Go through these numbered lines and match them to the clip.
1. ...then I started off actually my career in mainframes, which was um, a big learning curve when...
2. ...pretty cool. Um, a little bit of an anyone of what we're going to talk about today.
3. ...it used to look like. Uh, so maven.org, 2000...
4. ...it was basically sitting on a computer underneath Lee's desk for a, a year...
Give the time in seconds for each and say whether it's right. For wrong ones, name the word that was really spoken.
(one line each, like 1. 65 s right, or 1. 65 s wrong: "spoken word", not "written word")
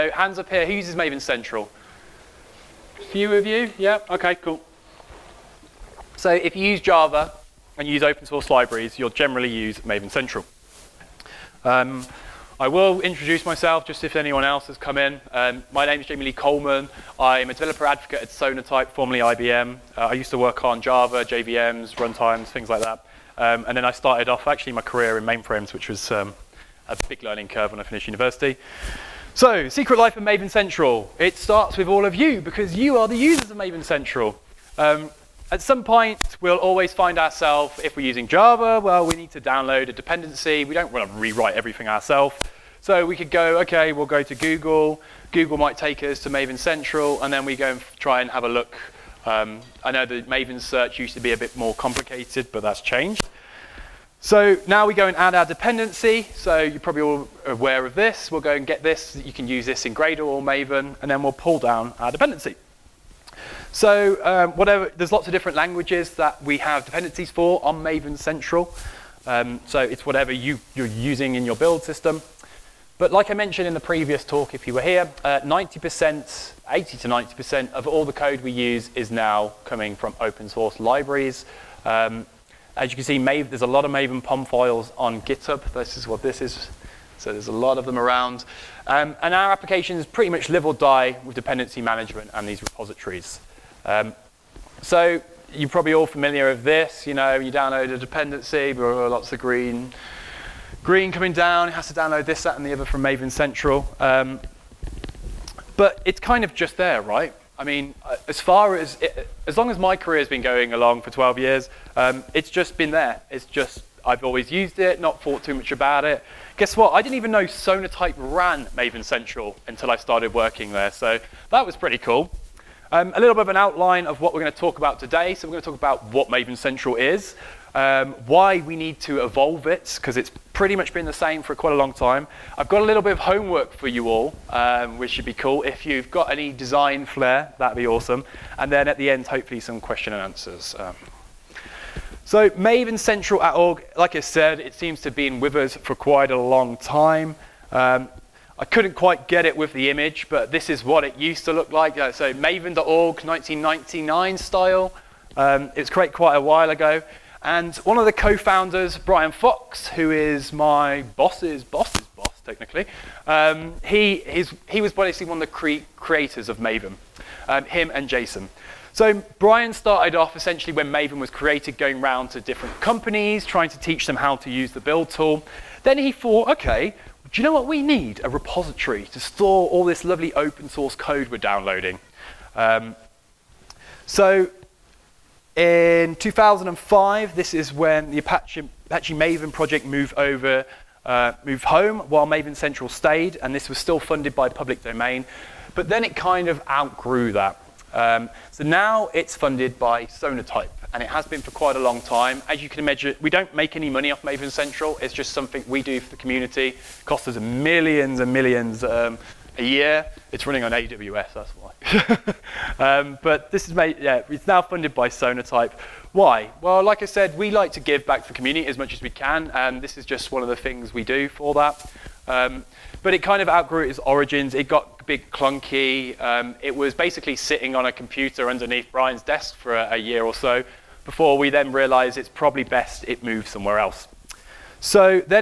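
1. 23 s right
2. 121 s wrong: "outline", not "anyone"
3. 151 s wrong: "1999", not "2000"
4. 226 s wrong: "Brian", not "Lee".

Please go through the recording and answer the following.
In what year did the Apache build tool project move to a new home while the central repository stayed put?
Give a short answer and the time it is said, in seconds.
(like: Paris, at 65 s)
2005, at 186 s.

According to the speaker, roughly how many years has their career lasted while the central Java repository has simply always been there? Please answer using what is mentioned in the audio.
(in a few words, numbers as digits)
12 years.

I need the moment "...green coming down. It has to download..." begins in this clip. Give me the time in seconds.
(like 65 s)
100 s.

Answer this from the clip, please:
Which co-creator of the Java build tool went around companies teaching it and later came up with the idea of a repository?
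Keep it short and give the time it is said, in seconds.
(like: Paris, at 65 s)
Brian Fox, at 158 s.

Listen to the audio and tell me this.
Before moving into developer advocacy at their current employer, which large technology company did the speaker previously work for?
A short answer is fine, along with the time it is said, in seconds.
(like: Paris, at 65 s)
IBM, at 19 s.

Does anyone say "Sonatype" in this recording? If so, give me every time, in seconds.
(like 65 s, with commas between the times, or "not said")
18 s, 117 s, 200 s, 215 s.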